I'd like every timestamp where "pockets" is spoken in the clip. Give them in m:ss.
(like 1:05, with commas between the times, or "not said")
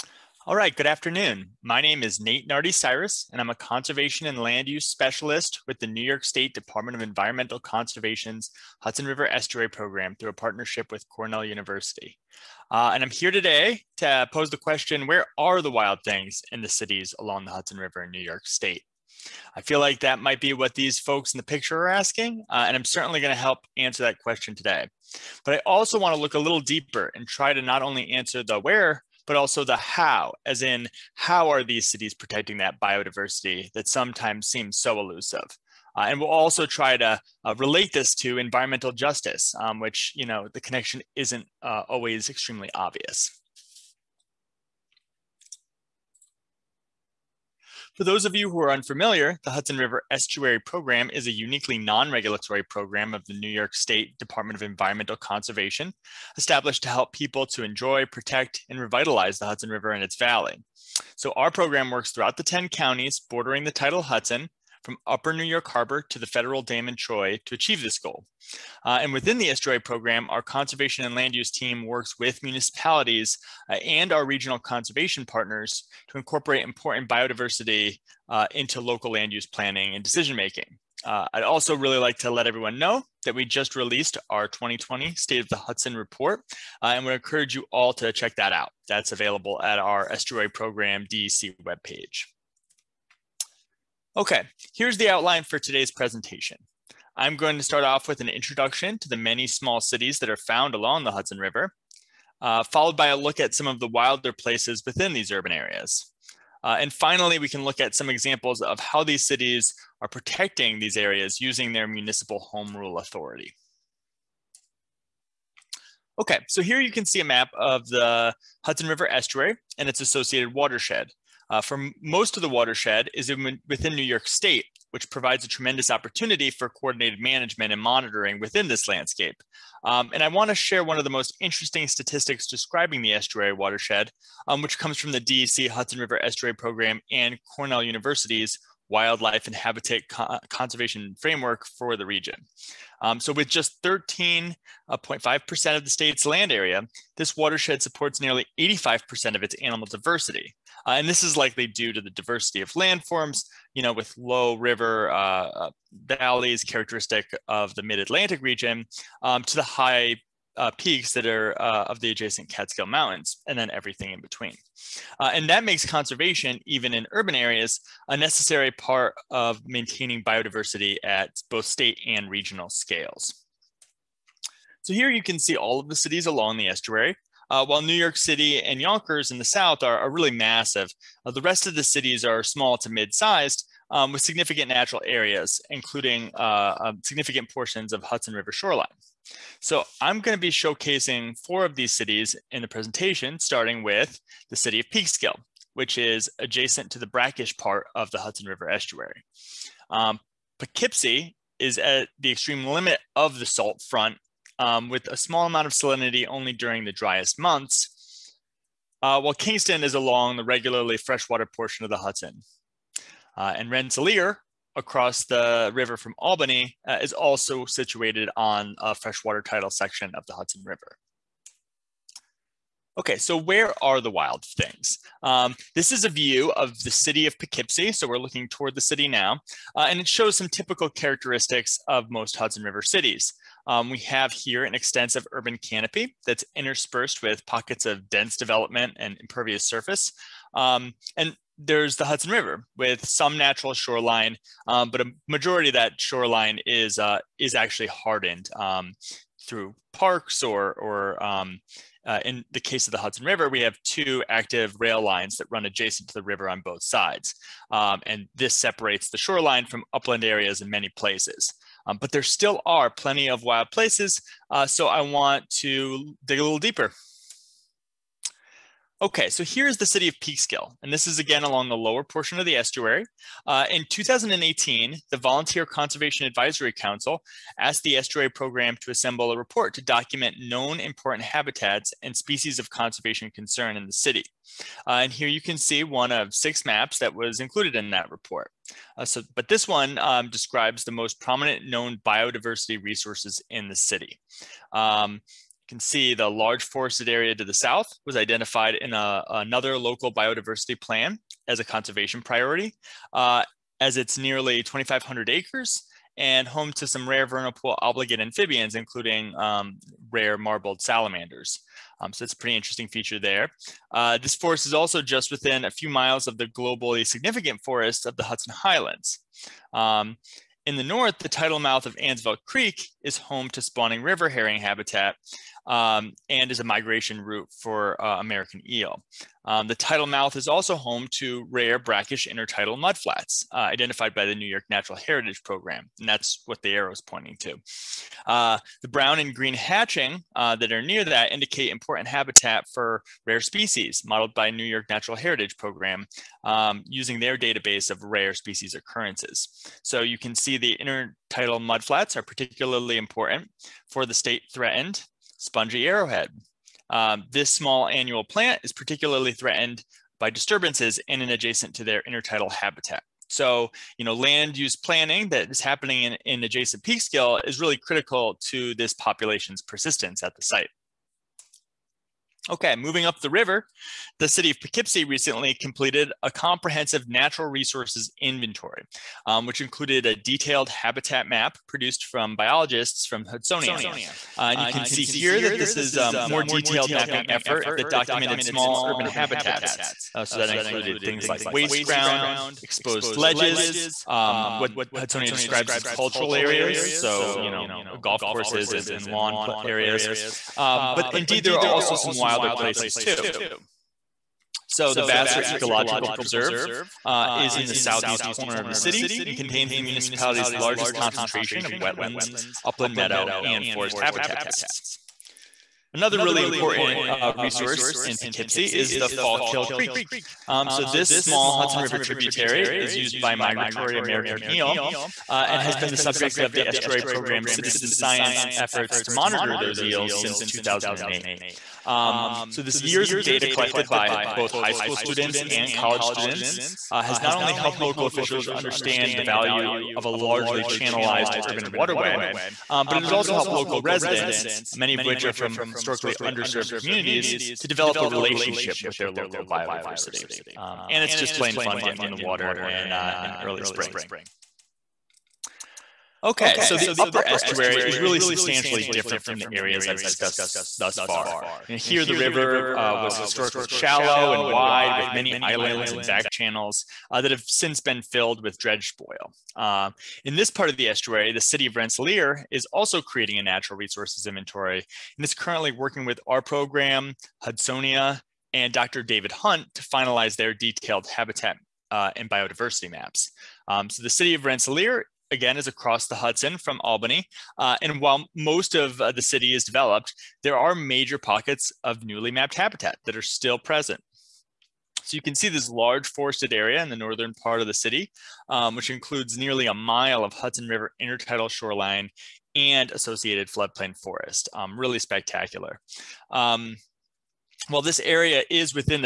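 3:57, 8:11.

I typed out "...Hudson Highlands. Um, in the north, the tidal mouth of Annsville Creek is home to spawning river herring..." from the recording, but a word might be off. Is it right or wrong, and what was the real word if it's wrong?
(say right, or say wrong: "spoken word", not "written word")
right.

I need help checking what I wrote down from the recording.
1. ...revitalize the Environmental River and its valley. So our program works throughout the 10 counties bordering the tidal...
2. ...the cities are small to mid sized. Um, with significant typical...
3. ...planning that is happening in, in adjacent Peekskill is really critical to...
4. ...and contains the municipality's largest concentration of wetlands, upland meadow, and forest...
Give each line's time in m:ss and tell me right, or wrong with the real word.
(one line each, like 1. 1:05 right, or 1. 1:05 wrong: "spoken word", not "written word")
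1. 0:58 wrong: "Hudson", not "Environmental"
2. 3:01 wrong: "natural", not "typical"
3. 6:04 right
4. 6:49 right.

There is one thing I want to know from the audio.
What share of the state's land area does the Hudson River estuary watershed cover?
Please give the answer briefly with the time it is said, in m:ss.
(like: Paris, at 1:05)
13.5%, at 2:23.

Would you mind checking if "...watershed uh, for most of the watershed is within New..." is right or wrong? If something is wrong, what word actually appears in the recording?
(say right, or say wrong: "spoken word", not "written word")
right.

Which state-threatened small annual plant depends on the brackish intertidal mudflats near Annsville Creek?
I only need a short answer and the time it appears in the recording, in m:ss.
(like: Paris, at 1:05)
Spongy arrowhead, at 5:55.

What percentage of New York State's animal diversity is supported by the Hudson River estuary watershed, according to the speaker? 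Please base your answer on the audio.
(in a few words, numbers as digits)
85%.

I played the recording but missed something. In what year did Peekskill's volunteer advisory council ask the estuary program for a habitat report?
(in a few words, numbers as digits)
2018.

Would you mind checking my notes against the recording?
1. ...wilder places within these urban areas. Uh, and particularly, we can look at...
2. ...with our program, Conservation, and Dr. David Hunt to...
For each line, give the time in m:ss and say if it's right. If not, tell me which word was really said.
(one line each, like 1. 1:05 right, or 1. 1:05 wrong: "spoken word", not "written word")
1. 1:43 wrong: "finally", not "particularly"
2. 7:56 wrong: "Hudsonia", not "Conservation".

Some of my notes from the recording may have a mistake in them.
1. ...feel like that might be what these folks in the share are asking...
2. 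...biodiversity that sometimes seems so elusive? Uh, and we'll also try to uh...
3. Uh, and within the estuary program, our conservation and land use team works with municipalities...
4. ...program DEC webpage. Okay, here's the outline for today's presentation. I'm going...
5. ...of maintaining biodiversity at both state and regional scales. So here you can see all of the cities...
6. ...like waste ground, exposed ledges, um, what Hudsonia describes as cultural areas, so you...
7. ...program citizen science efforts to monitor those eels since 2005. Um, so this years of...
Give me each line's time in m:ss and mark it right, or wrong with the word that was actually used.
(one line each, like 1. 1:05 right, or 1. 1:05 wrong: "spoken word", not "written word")
1. 0:19 wrong: "picture", not "share"
2. 0:32 right
3. 1:08 right
4. 1:30 right
5. 2:49 right
6. 6:31 right
7. 7:07 wrong: "2008", not "2005".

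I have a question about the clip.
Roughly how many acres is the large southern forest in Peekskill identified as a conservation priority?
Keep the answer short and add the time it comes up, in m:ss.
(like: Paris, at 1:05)
2,500 acres, at 5:04.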